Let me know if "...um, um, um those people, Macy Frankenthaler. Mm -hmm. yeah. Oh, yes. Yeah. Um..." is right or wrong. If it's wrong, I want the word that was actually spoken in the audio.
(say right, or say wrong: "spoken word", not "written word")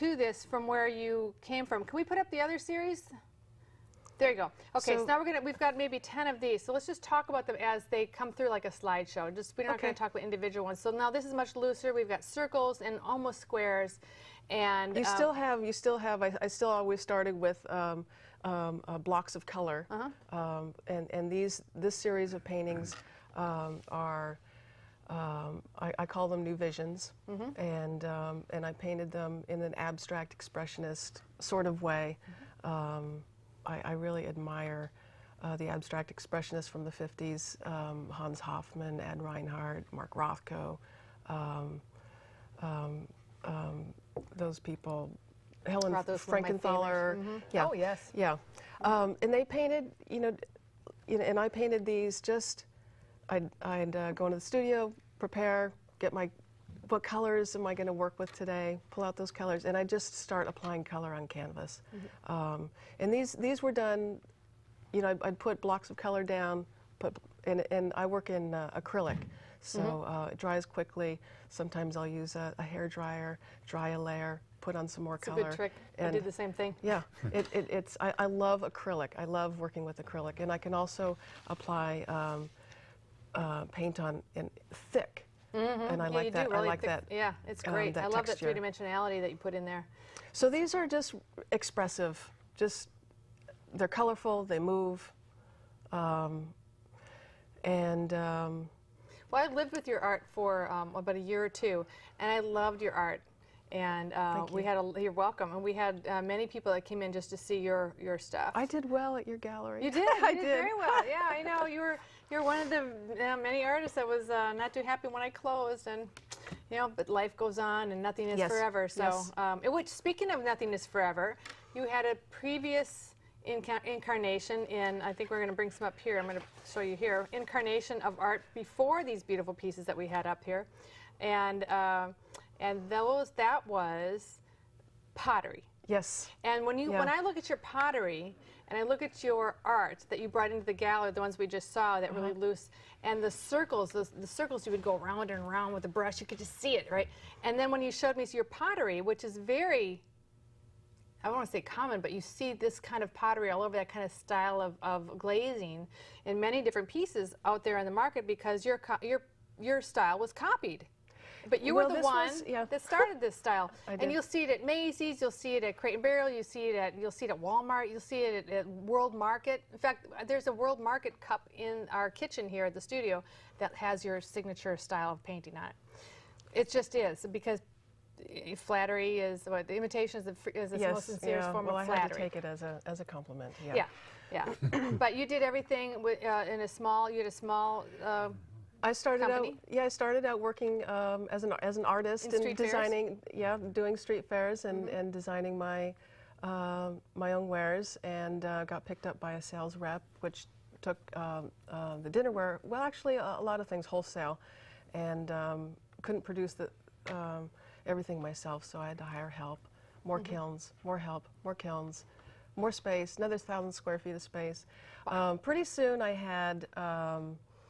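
wrong: "Helen", not "Macy".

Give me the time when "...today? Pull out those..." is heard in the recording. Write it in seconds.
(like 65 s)
58 s.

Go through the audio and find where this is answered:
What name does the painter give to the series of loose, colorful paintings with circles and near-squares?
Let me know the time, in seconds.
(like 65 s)
26 s.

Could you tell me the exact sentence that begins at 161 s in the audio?
But you well, were the one was, yeah.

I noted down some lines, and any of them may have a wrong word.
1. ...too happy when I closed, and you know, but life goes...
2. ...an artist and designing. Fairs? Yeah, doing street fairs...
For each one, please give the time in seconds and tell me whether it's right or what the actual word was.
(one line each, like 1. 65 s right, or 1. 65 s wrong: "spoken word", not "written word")
1. 114 s right
2. 191 s right.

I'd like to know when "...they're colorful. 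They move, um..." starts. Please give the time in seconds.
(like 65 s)
93 s.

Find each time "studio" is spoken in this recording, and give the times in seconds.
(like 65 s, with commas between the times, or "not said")
54 s, 172 s.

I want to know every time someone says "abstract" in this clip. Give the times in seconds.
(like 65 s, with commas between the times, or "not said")
29 s, 35 s.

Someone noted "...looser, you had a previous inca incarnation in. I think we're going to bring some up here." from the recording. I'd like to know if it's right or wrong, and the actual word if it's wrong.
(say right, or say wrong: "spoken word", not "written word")
wrong: "forever", not "looser".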